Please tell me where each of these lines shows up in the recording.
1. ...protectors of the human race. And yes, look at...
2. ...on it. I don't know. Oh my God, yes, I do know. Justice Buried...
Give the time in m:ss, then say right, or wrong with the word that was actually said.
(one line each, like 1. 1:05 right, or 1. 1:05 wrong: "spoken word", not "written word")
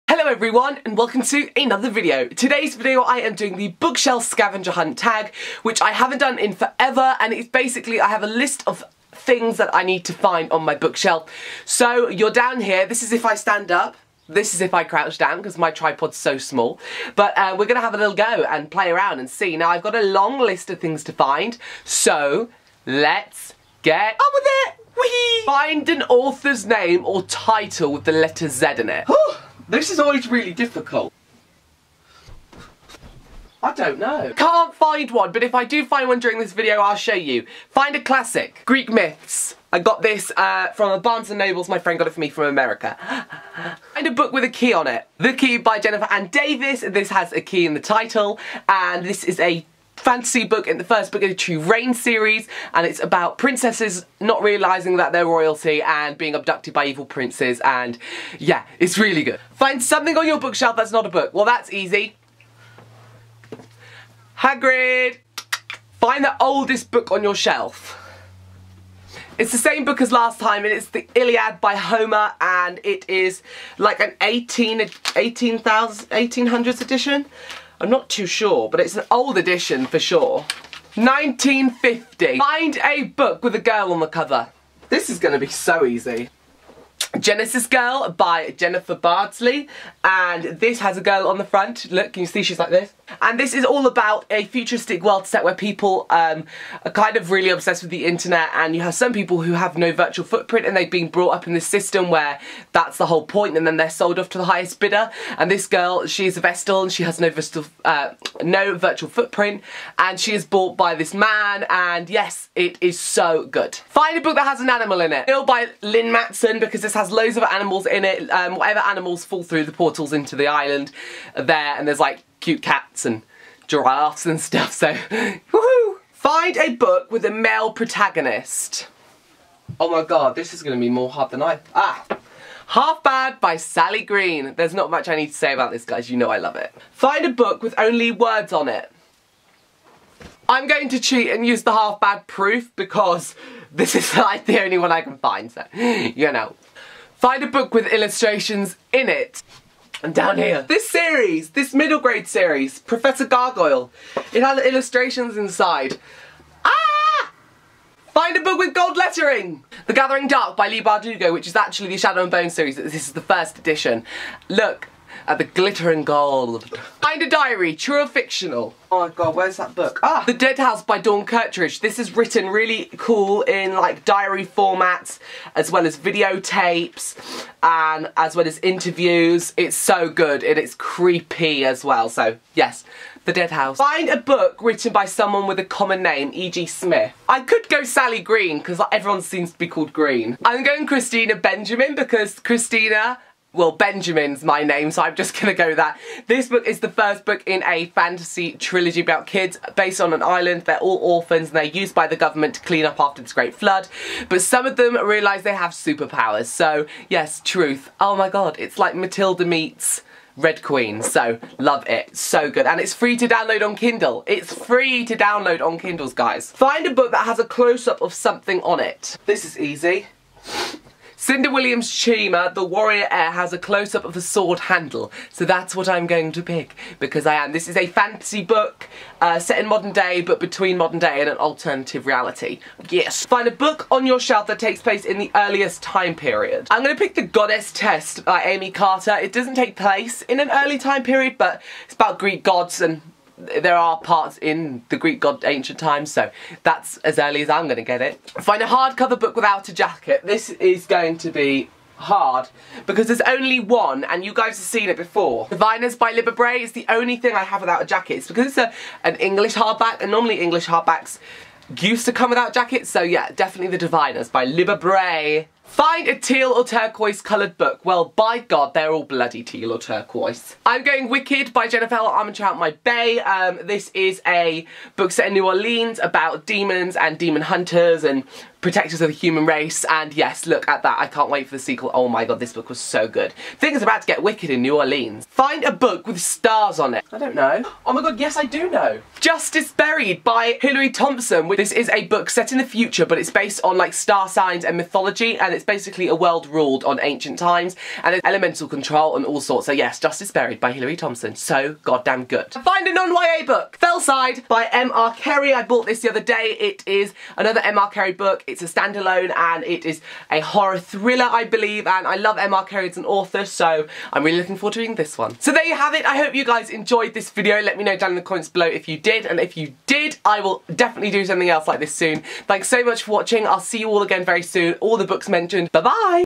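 1. 4:38 right
2. 4:46 right.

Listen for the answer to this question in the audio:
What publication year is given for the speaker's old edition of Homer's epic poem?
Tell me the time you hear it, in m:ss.
1:20.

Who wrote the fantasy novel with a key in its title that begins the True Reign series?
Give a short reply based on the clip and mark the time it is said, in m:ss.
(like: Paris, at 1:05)
Jennifer Anne Davies, at 0:45.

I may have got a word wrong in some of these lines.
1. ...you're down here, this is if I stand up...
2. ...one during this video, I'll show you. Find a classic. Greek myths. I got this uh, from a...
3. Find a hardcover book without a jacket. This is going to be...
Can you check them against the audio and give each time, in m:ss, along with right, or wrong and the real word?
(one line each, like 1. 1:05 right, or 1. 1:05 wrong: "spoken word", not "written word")
1. 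0:12 right
2. 0:36 right
3. 4:08 right.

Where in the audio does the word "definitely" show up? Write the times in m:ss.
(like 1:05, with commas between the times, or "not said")
4:23, 5:20.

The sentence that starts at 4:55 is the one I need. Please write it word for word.
And it's it's basically a world ruled on ancient times and it's elemental control and all sorts.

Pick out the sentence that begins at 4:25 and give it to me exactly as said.
Find a teal or turquoise coloured book.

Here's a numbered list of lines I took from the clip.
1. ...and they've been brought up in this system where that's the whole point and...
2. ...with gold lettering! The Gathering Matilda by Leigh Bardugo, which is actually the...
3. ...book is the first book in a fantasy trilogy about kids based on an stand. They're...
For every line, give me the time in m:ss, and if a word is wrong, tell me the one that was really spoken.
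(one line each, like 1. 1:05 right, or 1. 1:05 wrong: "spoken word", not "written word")
1. 1:40 right
2. 2:38 wrong: "Dark", not "Matilda"
3. 3:16 wrong: "island", not "stand".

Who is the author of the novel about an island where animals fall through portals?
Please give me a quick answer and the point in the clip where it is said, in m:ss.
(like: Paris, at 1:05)
Lynne Matson, at 1:55.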